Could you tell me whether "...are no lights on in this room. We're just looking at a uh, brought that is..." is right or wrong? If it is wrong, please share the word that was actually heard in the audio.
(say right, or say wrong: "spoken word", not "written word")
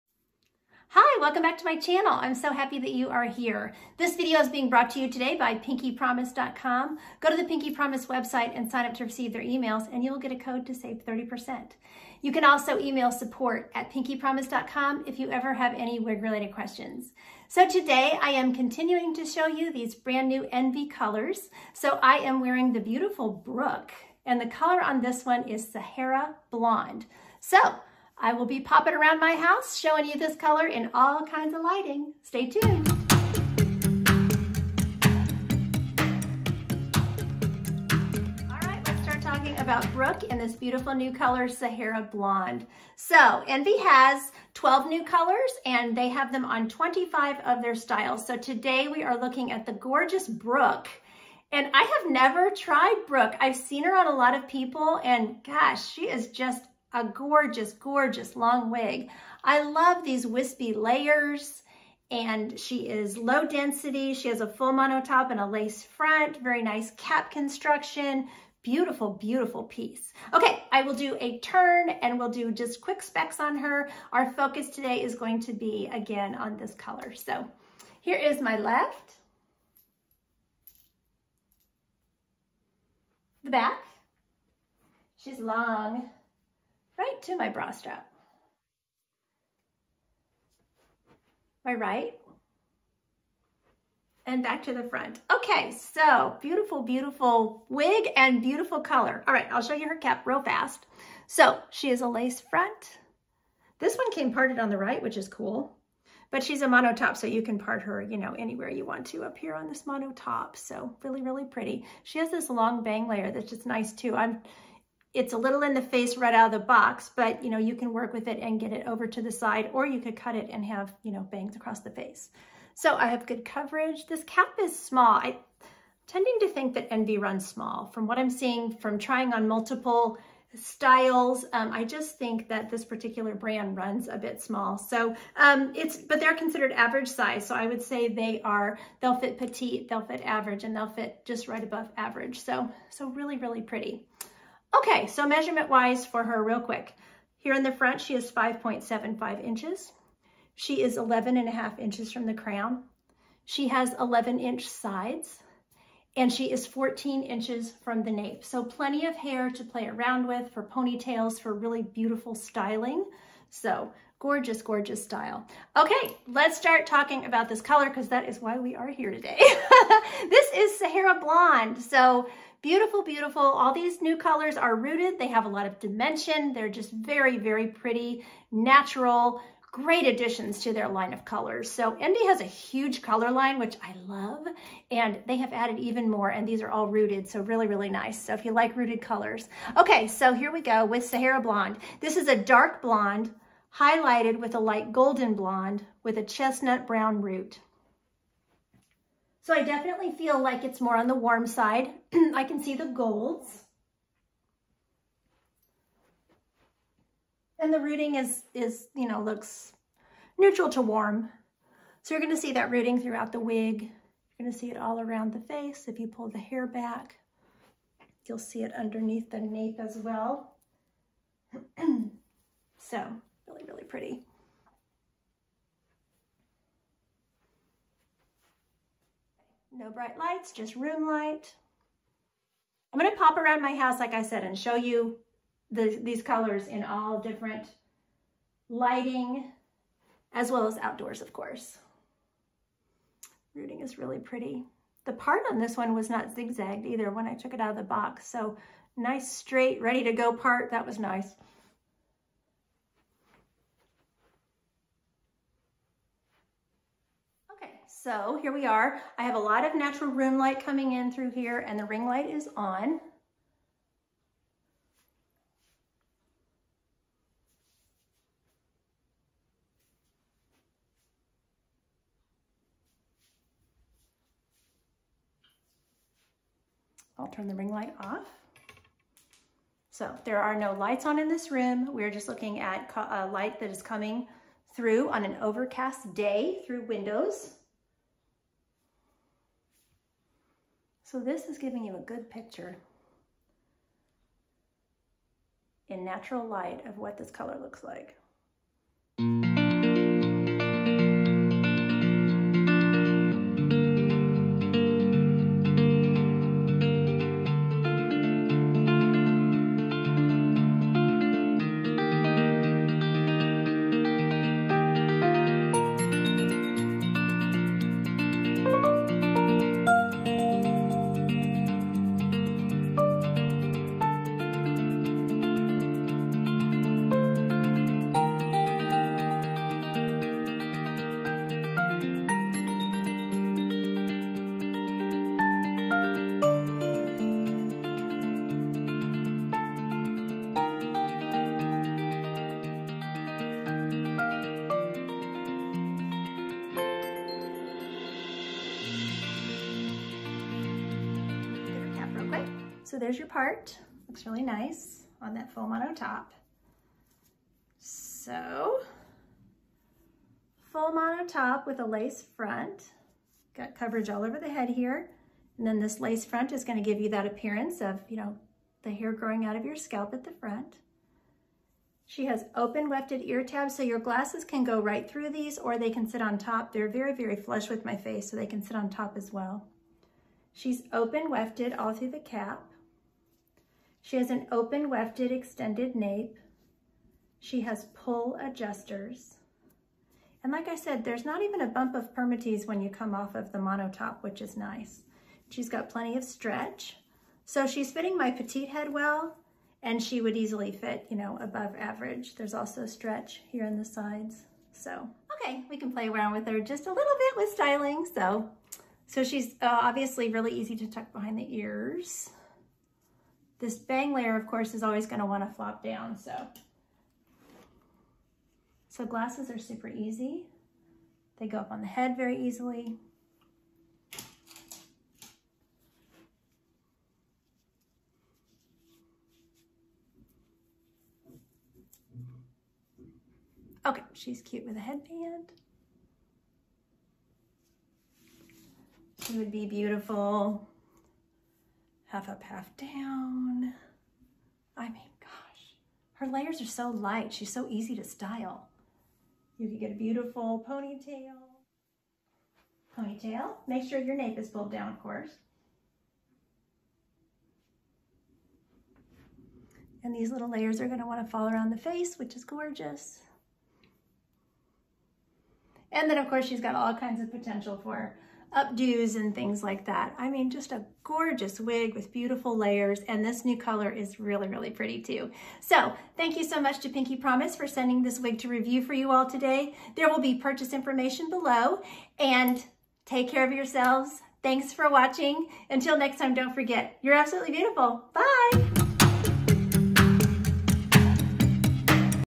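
wrong: "light", not "brought".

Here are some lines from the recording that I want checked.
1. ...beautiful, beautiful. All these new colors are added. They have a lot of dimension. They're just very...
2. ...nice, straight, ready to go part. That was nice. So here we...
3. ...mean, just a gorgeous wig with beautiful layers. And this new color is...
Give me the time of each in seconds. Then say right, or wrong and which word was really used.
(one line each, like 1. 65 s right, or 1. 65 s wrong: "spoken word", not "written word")
1. 172 s wrong: "rooted", not "added"
2. 248 s right
3. 470 s right.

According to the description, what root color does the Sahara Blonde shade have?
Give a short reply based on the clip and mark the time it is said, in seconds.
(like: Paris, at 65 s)
chestnut brown, at 196 s.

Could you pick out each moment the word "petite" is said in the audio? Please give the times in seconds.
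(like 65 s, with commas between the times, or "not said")
139 s, 398 s.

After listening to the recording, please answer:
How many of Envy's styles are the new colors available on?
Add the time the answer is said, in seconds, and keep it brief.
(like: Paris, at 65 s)
25, at 46 s.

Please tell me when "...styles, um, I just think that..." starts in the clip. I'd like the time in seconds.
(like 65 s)
130 s.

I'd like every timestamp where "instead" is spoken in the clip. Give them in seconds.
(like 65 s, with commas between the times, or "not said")
not said.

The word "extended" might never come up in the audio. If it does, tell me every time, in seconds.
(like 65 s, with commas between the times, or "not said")
385 s.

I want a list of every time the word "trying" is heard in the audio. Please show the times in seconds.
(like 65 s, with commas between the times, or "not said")
128 s.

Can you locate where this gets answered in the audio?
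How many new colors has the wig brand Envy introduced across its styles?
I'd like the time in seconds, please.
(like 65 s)
44 s.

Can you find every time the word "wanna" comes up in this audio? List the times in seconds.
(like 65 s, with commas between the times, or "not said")
415 s, 461 s.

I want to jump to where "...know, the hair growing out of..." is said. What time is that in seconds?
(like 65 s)
368 s.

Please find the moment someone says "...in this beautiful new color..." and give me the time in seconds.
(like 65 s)
40 s.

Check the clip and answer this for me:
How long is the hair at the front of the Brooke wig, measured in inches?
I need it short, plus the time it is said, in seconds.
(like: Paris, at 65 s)
5.75 inches, at 148 s.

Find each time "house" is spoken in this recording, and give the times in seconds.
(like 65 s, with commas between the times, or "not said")
29 s, 233 s.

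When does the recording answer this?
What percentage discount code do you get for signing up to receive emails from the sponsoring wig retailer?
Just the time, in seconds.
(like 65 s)
11 s.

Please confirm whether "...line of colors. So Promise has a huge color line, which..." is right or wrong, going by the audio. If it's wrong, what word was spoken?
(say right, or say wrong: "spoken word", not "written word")
wrong: "Envy", not "Promise".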